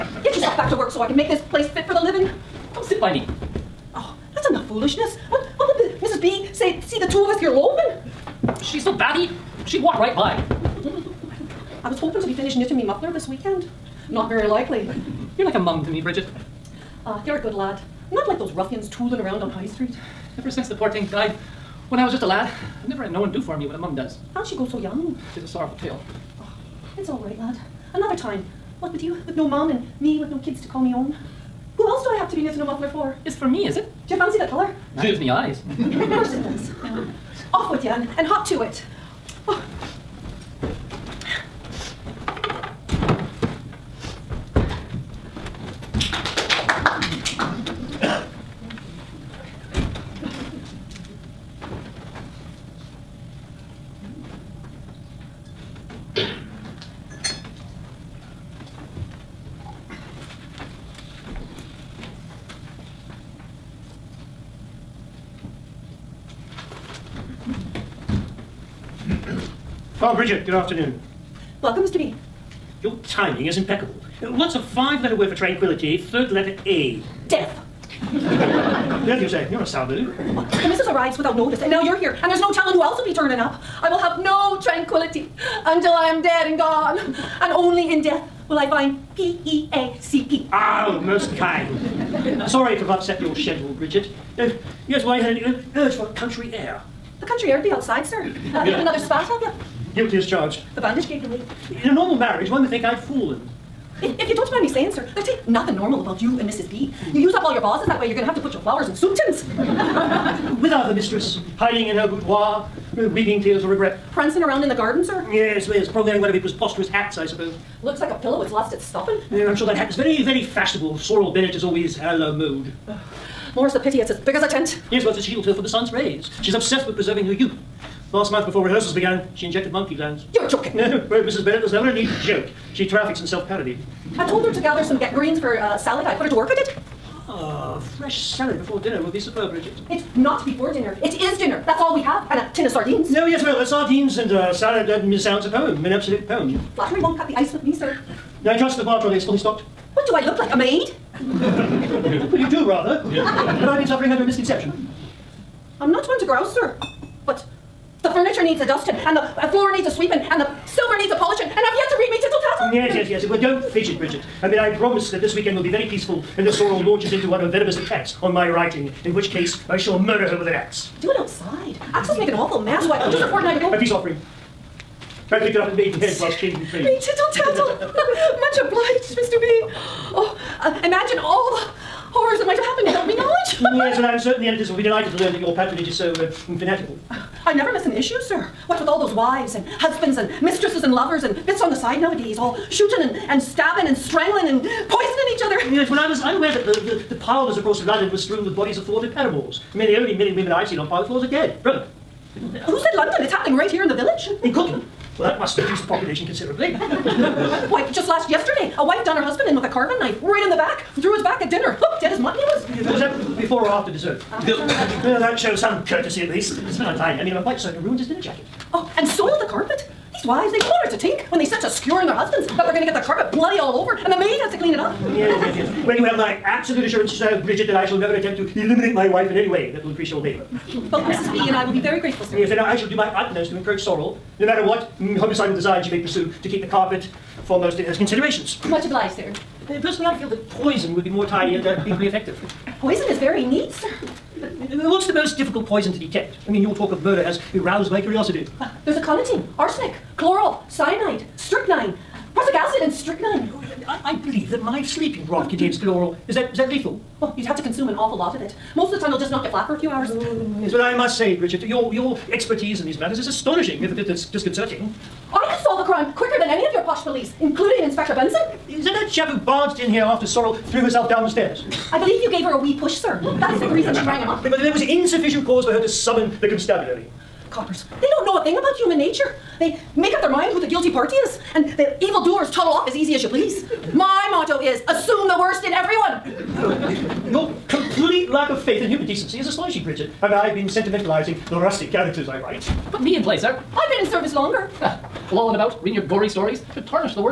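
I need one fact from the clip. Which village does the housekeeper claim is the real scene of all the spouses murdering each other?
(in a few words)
Cookham.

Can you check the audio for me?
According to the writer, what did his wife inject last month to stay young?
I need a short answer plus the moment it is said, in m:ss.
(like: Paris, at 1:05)
Monkey glands, at 2:09.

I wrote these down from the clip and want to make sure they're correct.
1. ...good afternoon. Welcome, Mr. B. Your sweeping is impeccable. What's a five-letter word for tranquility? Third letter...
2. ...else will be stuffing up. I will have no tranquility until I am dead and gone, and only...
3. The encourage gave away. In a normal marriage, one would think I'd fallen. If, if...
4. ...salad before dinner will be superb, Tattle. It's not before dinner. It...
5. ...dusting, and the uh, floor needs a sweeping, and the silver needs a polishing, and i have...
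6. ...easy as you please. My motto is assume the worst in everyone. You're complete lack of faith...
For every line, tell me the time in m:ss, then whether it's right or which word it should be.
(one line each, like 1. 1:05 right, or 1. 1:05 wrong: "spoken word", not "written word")
1. 1:10 wrong: "timing", not "sweeping"
2. 1:22 wrong: "turning", not "stuffing"
3. 1:40 wrong: "bandage", not "encourage"
4. 2:18 wrong: "Bridget", not "Tattle"
5. 2:38 right
6. 4:42 right.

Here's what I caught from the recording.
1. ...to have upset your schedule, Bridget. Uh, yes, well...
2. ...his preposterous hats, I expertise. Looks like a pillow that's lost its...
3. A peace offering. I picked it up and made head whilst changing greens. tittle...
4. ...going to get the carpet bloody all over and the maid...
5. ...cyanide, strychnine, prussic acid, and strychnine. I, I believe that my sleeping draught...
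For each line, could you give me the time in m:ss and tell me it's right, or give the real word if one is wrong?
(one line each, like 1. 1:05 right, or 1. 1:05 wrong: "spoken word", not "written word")
1. 1:32 right
2. 1:56 wrong: "suppose", not "expertise"
3. 2:53 wrong: "trains", not "greens"
4. 3:42 right
5. 4:10 right.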